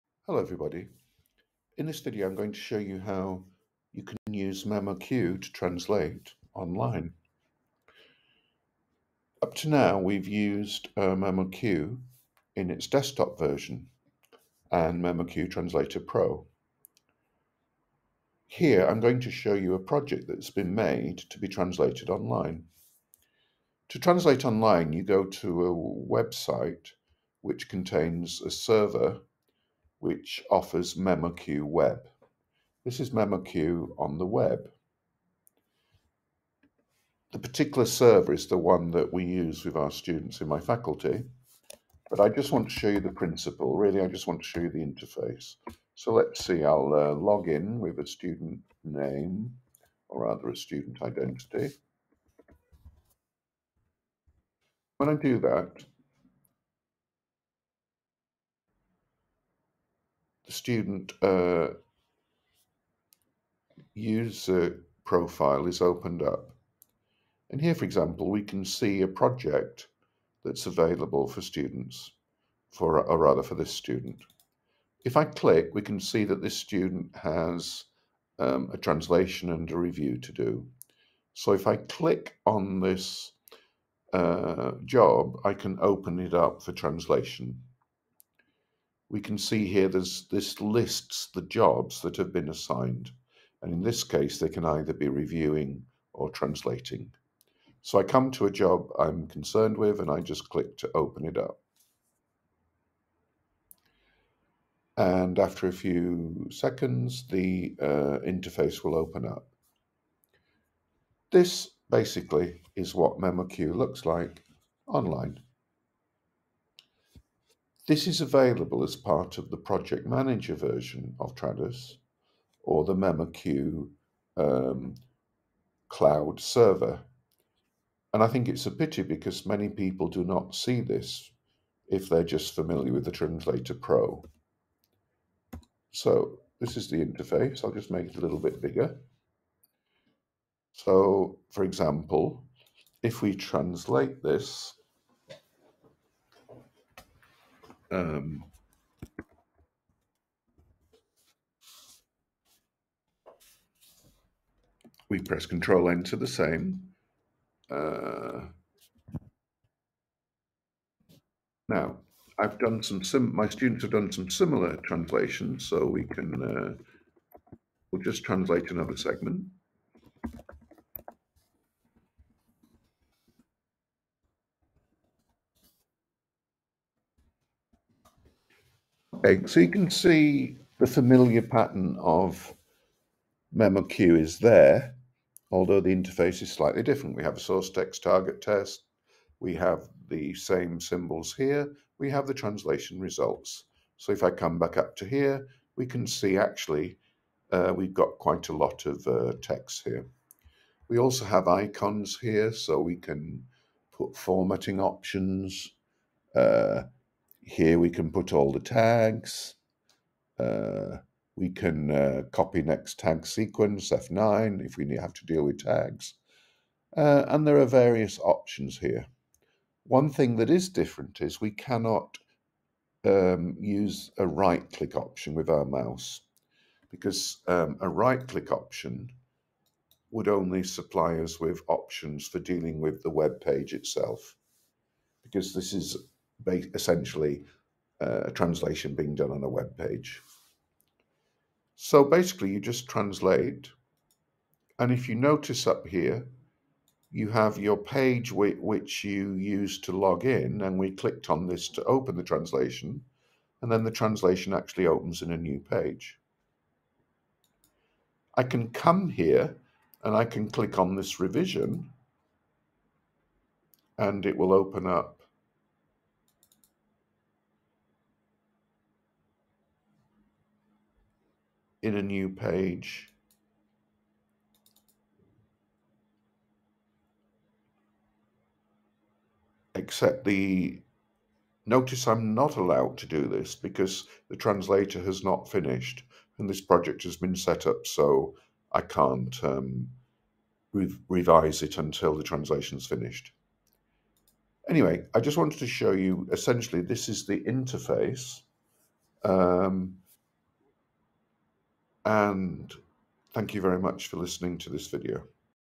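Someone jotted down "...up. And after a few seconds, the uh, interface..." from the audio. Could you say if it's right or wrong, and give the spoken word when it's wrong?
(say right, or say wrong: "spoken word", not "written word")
right.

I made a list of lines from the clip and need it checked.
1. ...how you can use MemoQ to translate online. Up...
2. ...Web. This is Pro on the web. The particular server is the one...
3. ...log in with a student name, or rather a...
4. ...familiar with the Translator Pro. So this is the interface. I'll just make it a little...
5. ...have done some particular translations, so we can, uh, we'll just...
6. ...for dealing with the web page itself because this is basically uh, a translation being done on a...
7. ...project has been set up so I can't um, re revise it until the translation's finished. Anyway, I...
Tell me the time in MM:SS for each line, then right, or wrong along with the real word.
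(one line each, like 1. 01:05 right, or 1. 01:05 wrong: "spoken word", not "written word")
1. 00:02 right
2. 00:31 wrong: "MemoQ", not "Pro"
3. 00:47 right
4. 02:12 right
5. 02:43 wrong: "similar", not "particular"
6. 03:52 wrong: "essentially", not "basically"
7. 04:46 right.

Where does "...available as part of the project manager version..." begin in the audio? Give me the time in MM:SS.
01:58.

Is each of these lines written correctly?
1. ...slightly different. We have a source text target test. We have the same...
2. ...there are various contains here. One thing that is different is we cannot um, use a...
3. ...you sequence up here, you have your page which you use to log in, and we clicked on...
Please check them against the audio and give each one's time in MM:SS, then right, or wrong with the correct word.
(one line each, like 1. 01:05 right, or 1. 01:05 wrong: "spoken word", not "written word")
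1. 03:06 right
2. 03:37 wrong: "options", not "contains"
3. 04:05 wrong: "notice", not "sequence".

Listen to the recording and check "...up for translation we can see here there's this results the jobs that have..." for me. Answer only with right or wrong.
wrong.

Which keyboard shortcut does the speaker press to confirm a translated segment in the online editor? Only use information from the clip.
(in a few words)
Control Enter.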